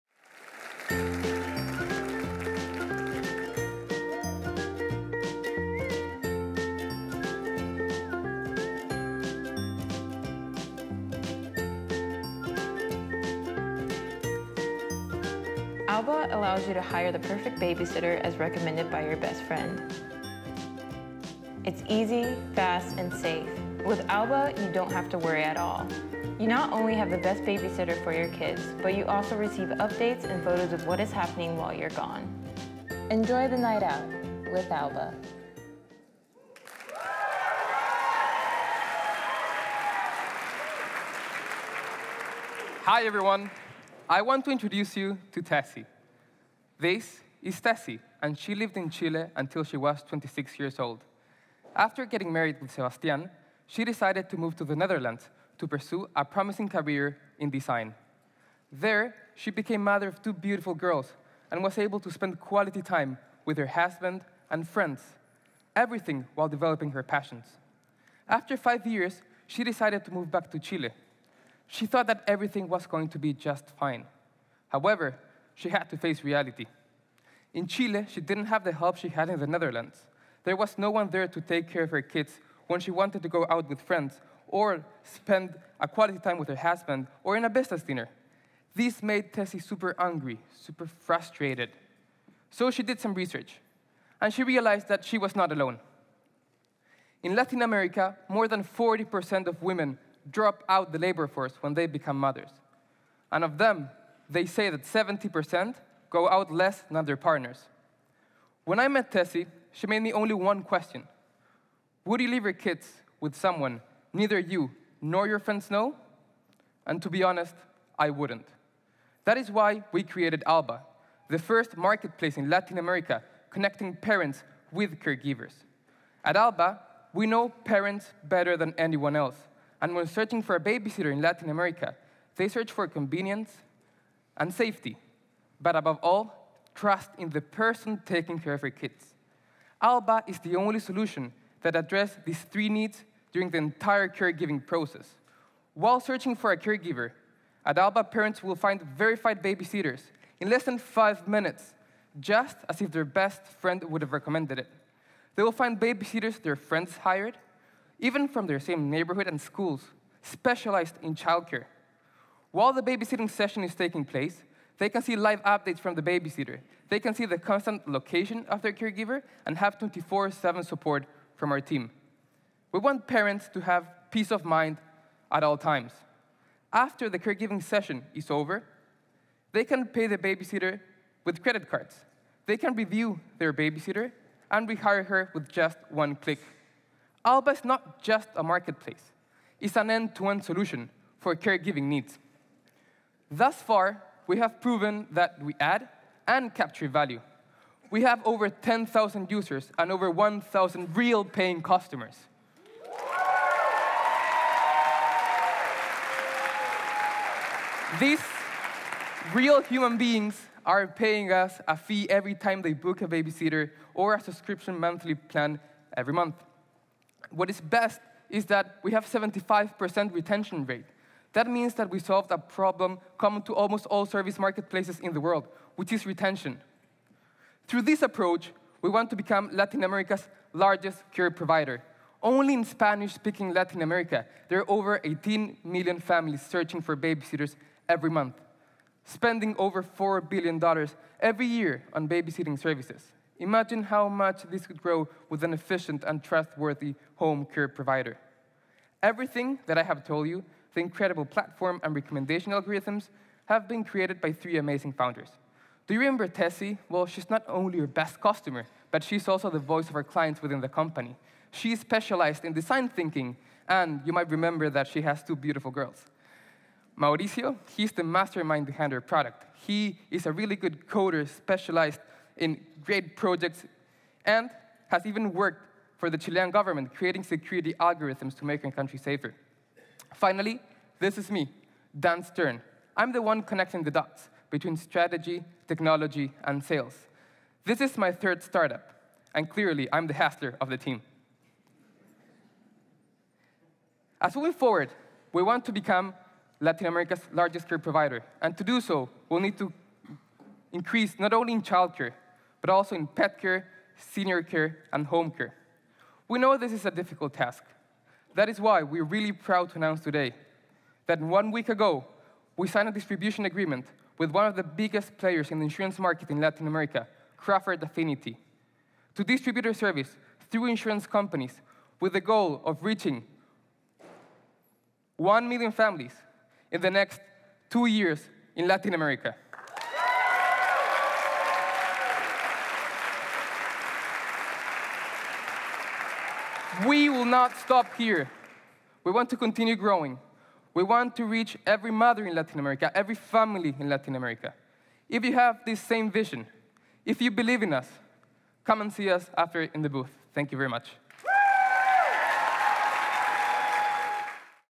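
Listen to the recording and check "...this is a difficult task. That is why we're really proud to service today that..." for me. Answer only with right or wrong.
wrong.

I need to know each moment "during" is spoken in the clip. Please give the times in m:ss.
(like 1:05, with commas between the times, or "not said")
2:23.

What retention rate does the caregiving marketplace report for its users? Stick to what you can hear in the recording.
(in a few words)
75%.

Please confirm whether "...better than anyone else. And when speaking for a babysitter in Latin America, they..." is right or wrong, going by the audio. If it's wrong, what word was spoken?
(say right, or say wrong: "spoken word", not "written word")
wrong: "searching", not "speaking".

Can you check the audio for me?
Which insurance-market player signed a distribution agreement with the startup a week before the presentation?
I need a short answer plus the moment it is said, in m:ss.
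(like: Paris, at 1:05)
Crawford Affinity, at 5:17.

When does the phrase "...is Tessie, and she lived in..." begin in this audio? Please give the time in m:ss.
0:47.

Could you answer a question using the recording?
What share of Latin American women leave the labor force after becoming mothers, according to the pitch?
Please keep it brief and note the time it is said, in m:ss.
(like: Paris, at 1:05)
40%, at 1:38.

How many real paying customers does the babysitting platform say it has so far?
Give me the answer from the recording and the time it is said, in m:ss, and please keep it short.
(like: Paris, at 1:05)
1,000, at 3:20.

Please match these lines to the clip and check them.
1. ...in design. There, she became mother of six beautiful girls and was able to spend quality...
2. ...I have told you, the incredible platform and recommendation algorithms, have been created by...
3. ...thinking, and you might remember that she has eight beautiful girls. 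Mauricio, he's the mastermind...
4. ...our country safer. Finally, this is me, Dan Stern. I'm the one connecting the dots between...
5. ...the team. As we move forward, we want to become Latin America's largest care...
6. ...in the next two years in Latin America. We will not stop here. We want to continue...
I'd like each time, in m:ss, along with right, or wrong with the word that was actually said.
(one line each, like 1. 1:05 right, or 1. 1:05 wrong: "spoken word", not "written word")
1. 0:57 wrong: "two", not "six"
2. 4:09 right
3. 4:22 wrong: "two", not "eight"
4. 4:38 right
5. 4:50 right
6. 5:26 right.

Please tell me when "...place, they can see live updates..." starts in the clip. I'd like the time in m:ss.
2:44.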